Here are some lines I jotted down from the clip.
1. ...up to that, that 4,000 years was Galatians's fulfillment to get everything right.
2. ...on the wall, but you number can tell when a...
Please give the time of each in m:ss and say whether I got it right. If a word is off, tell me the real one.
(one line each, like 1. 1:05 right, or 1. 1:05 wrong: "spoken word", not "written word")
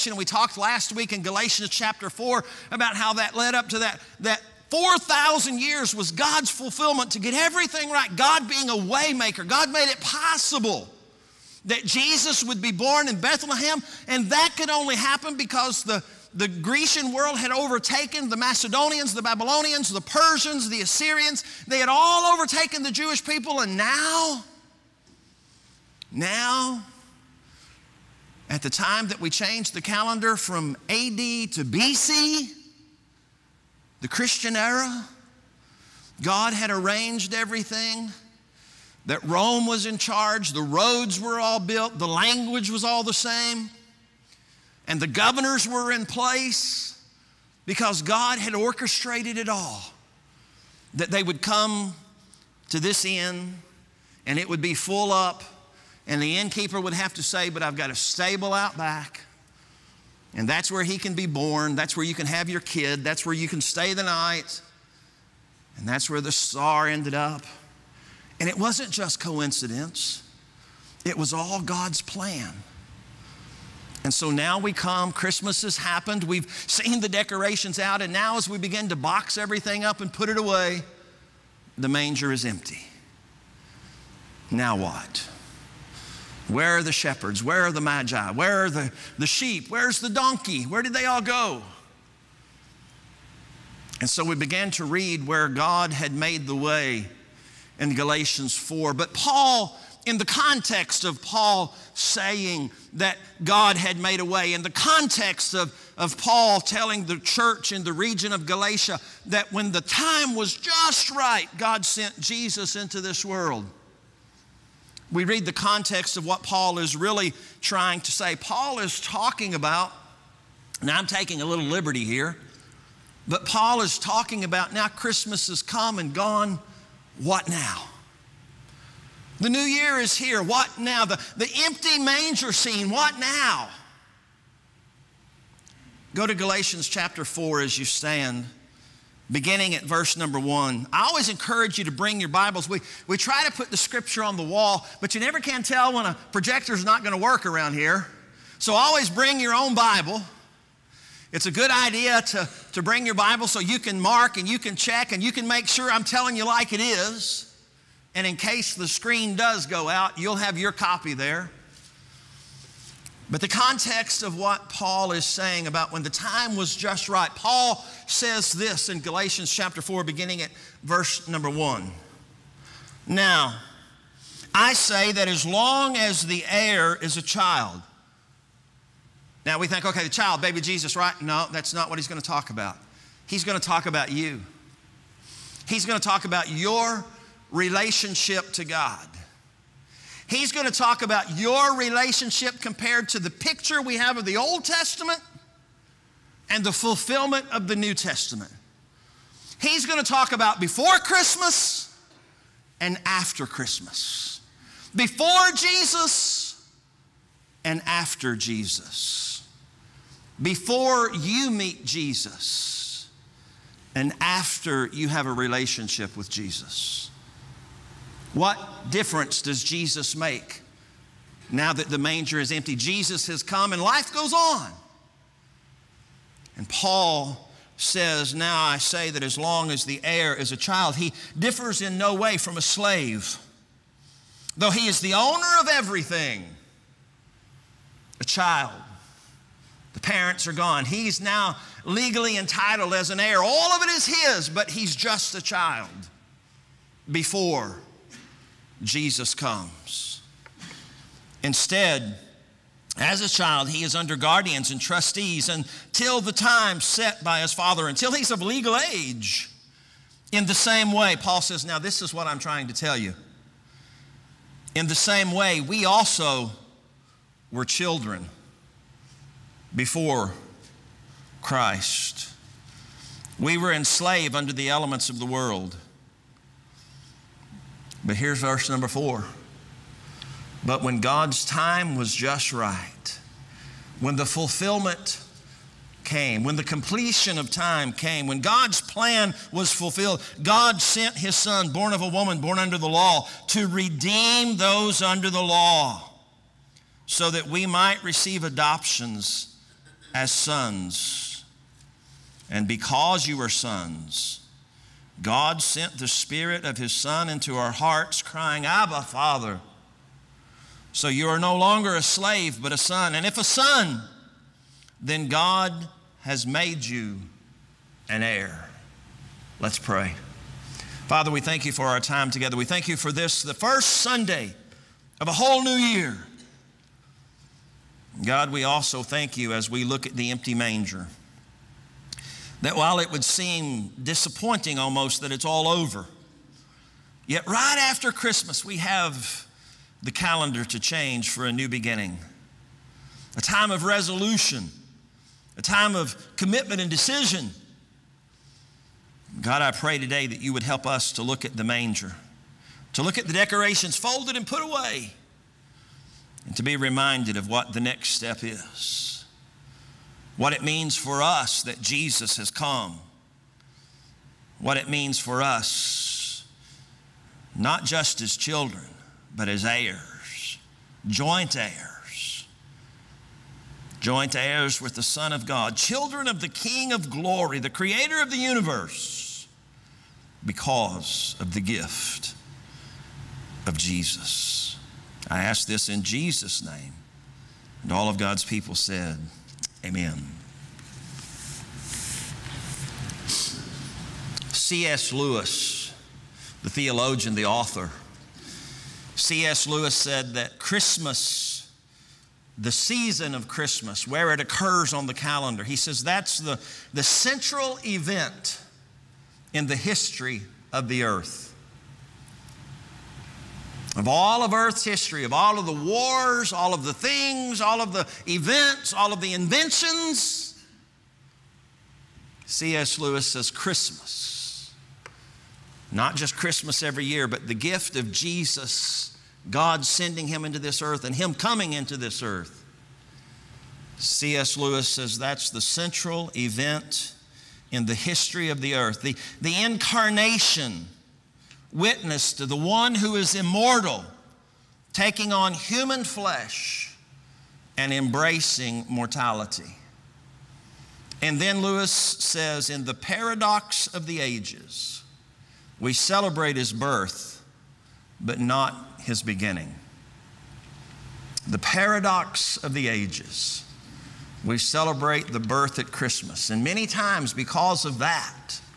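1. 0:03 wrong: "God", not "Galatians"
2. 2:24 wrong: "never", not "number".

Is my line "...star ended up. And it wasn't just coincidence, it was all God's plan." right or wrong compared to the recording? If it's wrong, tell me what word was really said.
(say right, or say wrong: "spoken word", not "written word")
right.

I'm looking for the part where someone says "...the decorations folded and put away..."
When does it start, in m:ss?
5:53.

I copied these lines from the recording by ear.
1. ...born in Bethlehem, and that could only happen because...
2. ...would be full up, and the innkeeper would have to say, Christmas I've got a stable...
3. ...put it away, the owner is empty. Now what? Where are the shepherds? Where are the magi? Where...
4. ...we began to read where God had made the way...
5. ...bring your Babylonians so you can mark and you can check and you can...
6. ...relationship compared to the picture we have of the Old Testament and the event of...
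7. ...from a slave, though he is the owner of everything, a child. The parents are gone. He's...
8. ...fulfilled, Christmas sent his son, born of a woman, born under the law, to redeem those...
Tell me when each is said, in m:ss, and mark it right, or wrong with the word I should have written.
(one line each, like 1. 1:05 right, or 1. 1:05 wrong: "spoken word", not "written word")
1. 0:12 right
2. 0:54 wrong: "But", not "Christmas"
3. 1:20 wrong: "manger", not "owner"
4. 1:34 right
5. 2:32 wrong: "Bible", not "Babylonians"
6. 3:11 wrong: "fulfillment", not "event"
7. 3:52 right
8. 4:49 wrong: "God", not "Christmas".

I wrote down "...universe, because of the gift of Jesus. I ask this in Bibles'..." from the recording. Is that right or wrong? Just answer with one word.
wrong.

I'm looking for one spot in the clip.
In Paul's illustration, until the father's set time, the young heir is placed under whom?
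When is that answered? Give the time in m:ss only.
4:14.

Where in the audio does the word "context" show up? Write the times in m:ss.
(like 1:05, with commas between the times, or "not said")
1:40, 1:44, 1:55, 2:43.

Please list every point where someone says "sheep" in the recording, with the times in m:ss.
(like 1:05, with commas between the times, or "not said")
1:29.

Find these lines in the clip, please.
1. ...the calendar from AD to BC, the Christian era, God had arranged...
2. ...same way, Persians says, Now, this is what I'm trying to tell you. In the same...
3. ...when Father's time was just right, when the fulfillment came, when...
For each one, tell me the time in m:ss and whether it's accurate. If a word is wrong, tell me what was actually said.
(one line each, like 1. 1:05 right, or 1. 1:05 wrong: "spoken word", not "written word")
1. 0:29 right
2. 4:20 wrong: "Paul", not "Persians"
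3. 4:40 wrong: "God", not "Father".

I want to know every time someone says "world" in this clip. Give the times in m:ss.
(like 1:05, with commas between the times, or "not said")
0:17, 1:53, 4:35.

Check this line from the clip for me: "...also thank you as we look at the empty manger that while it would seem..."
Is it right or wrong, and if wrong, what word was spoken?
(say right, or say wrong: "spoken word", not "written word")
right.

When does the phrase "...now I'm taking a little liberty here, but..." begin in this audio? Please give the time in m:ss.
2:00.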